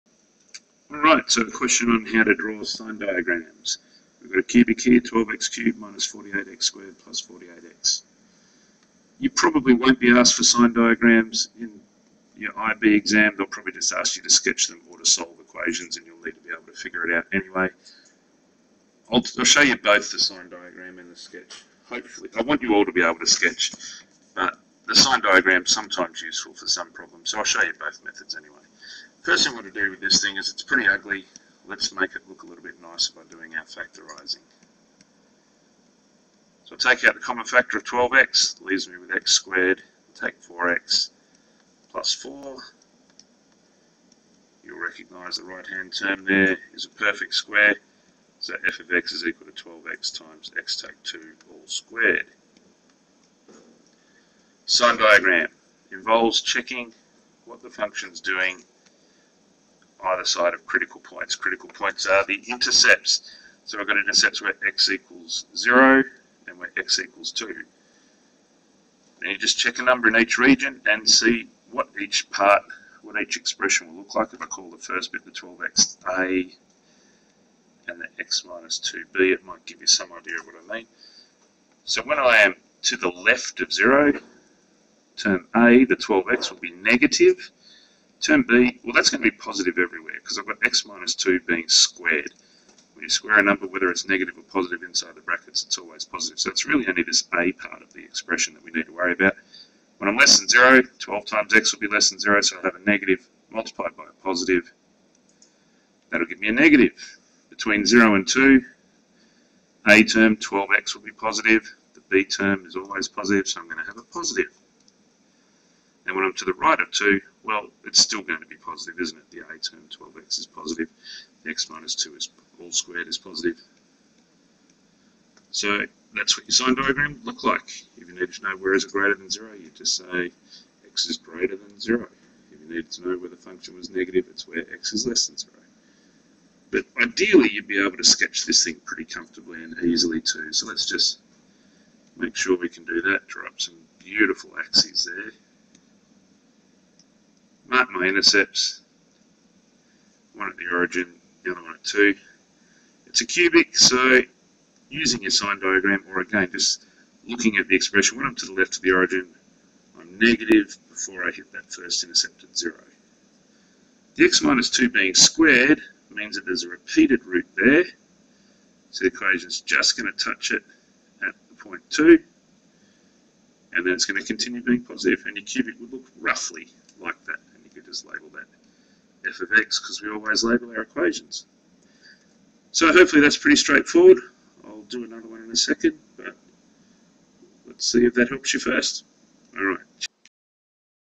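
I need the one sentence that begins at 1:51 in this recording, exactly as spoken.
The b term is always positive, so I'm going to have a positive.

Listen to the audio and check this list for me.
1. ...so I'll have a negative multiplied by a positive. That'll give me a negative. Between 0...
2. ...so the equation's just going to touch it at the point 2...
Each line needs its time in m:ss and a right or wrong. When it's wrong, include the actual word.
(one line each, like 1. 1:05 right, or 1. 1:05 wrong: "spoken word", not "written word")
1. 1:42 right
2. 2:48 right.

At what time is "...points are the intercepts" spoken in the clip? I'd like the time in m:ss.
1:01.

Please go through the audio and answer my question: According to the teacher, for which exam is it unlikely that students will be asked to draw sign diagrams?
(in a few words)
IB exam.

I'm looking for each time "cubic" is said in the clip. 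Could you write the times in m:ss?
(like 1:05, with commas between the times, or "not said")
0:04, 2:33, 2:55.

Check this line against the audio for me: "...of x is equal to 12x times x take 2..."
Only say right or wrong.
right.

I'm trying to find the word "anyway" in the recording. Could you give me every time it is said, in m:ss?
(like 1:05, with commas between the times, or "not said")
0:17, 0:28.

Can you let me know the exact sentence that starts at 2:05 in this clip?
So that's what your sign diagram look like.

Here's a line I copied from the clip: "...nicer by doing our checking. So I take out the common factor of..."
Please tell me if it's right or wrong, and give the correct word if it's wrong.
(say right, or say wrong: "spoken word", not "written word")
wrong: "factorising", not "checking".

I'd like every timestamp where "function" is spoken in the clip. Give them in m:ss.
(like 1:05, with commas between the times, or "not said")
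0:57, 2:13.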